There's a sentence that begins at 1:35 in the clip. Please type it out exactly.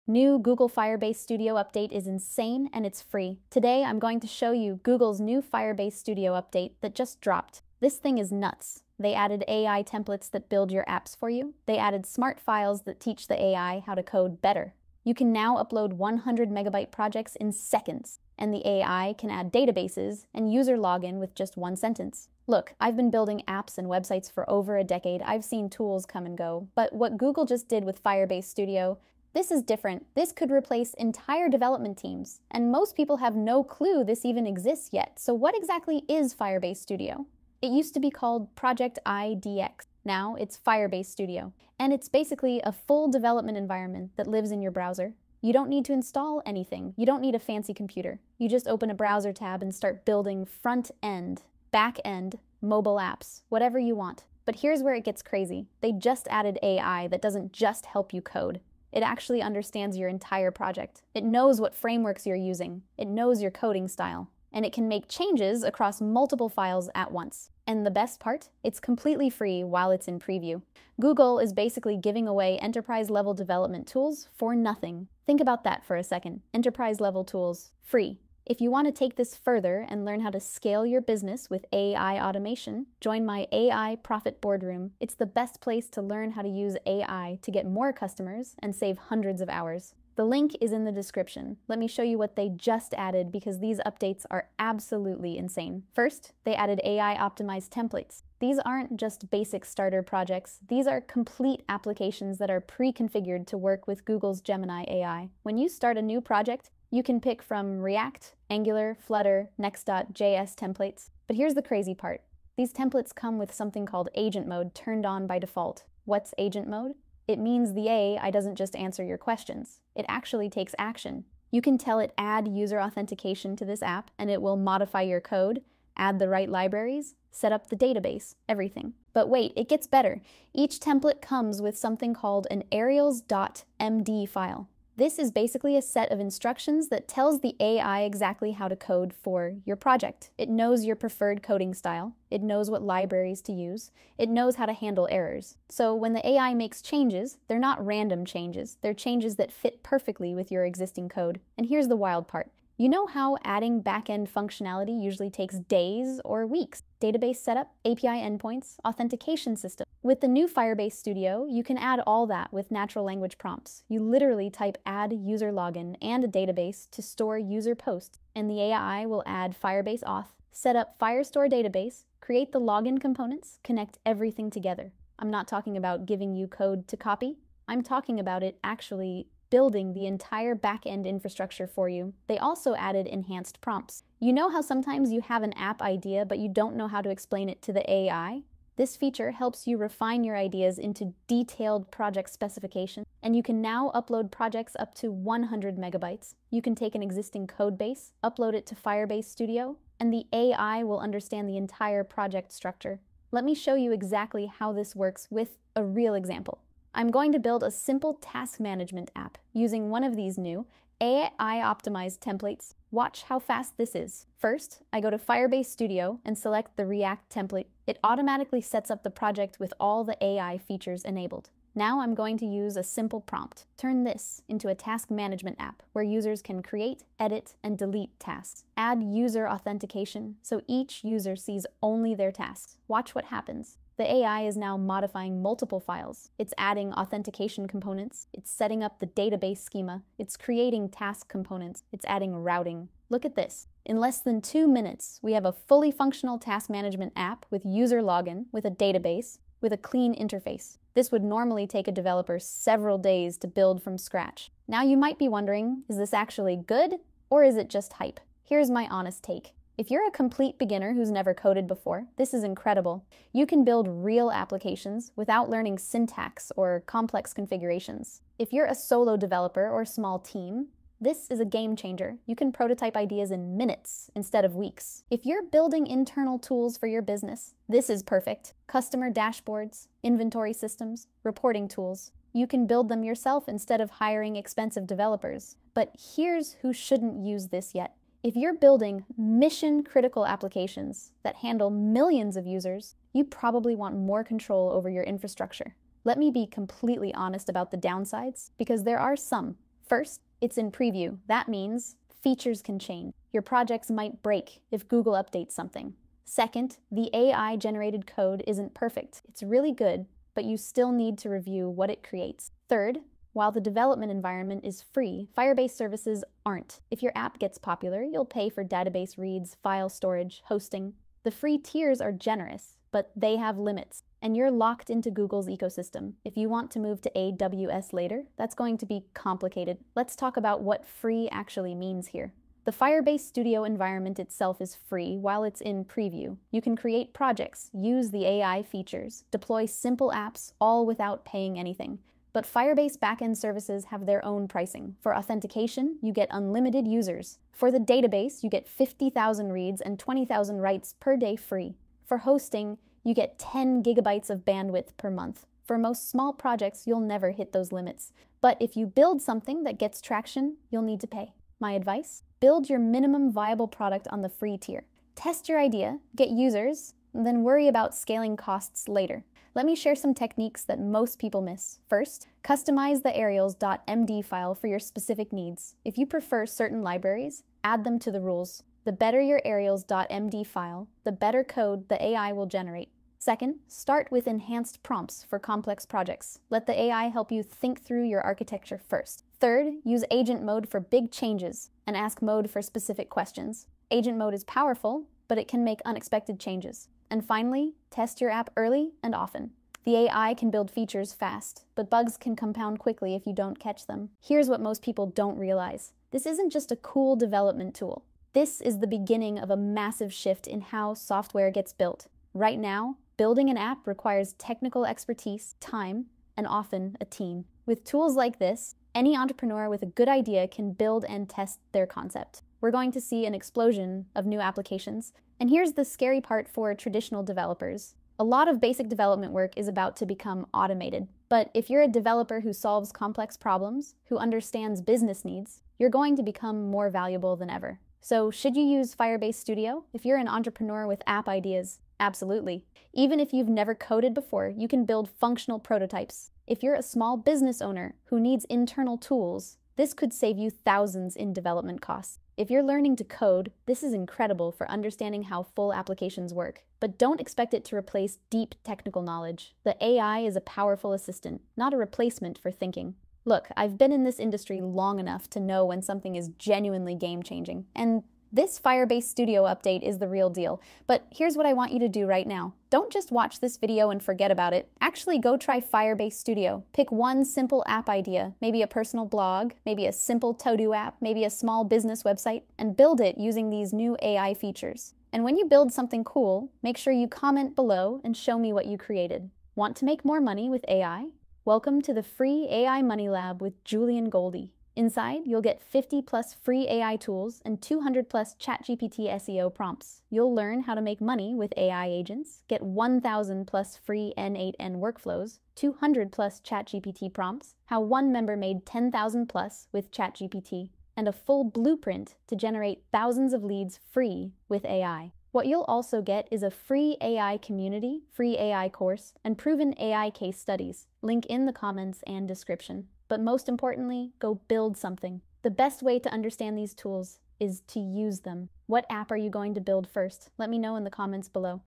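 First, they added AI optimized templates.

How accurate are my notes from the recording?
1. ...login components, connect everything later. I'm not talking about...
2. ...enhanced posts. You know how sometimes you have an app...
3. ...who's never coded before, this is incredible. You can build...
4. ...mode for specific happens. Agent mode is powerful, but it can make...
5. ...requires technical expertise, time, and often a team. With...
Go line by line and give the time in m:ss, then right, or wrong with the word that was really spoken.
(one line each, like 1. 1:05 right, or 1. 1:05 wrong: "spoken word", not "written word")
1. 2:52 wrong: "together", not "later"
2. 3:03 wrong: "prompts", not "posts"
3. 4:20 right
4. 6:32 wrong: "questions", not "happens"
5. 6:53 right.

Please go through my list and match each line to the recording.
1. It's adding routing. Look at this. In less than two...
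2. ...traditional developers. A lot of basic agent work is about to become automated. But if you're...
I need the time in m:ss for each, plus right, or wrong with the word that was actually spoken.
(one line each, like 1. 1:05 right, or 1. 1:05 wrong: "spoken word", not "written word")
1. 4:01 right
2. 7:06 wrong: "development", not "agent".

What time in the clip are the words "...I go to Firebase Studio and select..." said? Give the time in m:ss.
3:34.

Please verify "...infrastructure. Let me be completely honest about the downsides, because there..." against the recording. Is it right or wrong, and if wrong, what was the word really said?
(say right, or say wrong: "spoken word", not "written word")
right.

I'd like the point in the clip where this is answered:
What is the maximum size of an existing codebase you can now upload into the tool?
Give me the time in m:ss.
3:15.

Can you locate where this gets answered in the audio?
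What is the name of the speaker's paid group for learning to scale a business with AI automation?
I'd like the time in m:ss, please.
1:23.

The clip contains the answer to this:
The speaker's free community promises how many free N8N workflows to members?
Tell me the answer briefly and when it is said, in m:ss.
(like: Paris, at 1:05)
1,000+, at 8:22.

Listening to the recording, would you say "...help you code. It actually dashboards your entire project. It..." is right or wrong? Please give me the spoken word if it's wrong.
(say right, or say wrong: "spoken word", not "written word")
wrong: "understands", not "dashboards".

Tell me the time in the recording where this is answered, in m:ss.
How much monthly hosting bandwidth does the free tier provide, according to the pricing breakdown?
5:53.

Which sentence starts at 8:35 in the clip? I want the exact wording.
What you'll also get is a free AI community, free AI course, and proven AI case studies.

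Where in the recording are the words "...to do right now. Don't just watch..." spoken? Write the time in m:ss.
7:51.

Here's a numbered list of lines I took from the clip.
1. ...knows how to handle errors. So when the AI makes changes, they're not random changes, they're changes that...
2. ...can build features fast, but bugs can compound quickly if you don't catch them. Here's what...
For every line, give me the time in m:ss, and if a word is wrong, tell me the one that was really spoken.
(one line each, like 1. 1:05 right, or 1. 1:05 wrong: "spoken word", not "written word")
1. 2:24 right
2. 6:40 right.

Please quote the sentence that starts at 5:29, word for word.
Let's talk about what free actually means here.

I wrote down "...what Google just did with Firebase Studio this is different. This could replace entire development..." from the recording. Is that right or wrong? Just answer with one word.
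right.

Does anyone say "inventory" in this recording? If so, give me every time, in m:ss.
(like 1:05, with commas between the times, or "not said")
4:40.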